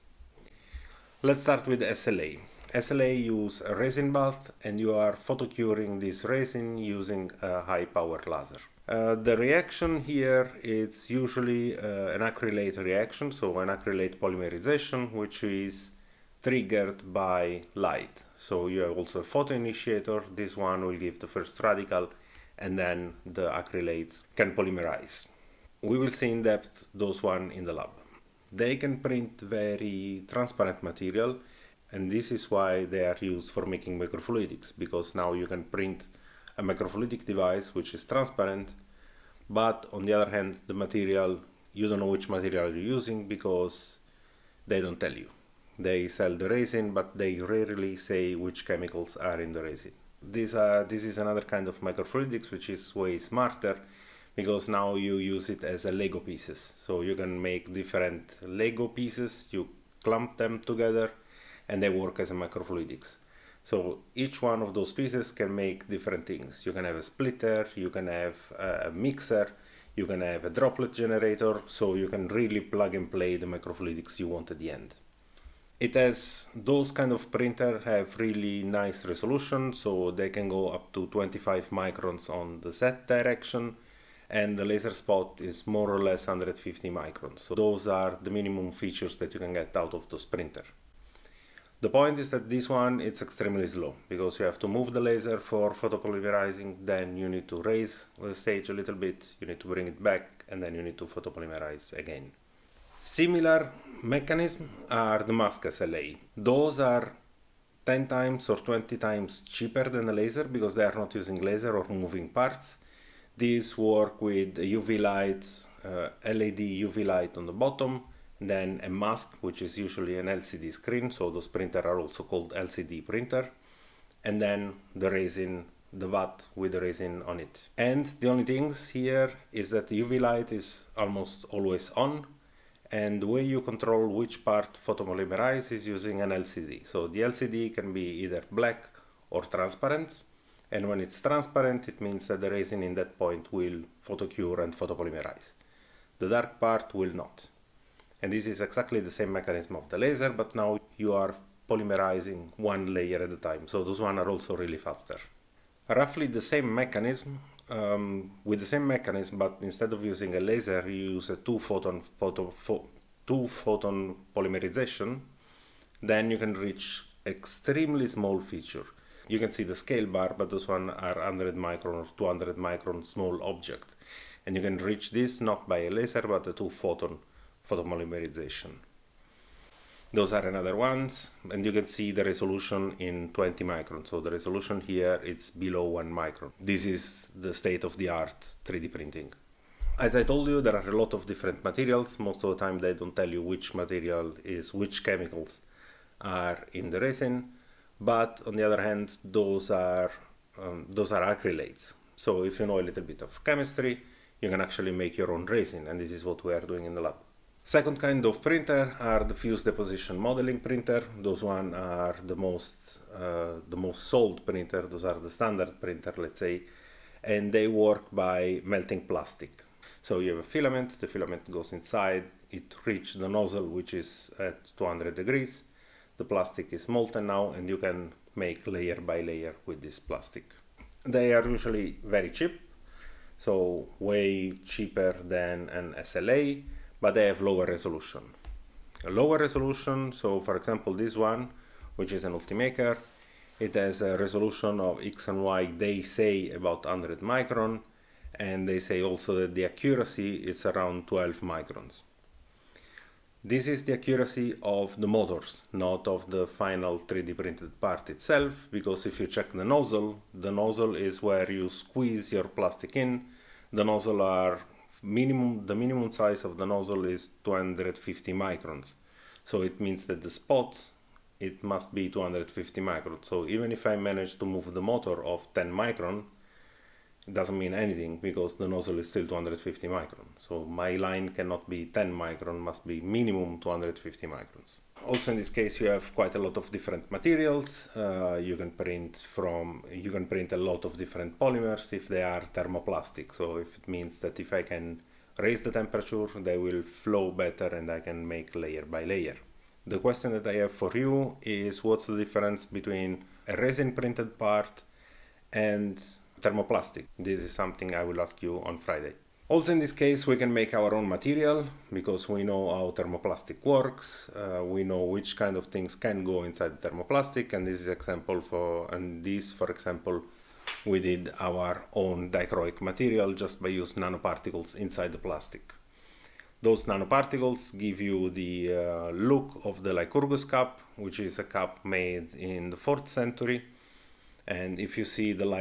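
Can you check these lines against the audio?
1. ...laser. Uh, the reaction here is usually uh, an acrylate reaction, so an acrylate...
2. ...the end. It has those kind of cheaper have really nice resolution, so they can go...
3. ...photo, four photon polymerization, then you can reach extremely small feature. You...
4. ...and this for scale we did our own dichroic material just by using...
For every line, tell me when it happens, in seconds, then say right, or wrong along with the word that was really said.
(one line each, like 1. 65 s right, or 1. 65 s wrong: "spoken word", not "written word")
1. 8 s right
2. 74 s wrong: "printer", not "cheaper"
3. 162 s wrong: "two", not "four"
4. 318 s wrong: "example", not "scale".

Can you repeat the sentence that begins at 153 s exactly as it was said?
So those one are also really faster.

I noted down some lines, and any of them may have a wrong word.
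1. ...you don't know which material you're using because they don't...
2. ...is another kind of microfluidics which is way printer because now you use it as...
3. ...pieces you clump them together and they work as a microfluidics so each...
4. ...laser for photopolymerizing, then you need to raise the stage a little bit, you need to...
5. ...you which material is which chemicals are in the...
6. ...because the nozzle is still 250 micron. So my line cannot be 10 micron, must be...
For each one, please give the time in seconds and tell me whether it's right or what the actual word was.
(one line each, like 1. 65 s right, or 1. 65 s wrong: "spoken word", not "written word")
1. 41 s right
2. 51 s wrong: "smarter", not "printer"
3. 58 s right
4. 95 s right
5. 193 s right
6. 278 s right.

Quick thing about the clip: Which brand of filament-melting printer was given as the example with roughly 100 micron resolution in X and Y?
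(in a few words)
Ultimaker.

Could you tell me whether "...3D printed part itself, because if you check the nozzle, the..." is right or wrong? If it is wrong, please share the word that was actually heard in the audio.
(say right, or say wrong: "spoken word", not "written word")
right.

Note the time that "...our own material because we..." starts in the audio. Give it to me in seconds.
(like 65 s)
310 s.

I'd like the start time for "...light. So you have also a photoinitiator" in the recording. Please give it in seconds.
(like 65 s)
17 s.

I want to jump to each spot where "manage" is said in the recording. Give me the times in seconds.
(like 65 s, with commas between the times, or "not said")
273 s.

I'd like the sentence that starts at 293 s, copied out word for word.
So if it means that if I can raise the temperature, they will flow better and I can make layer by layer.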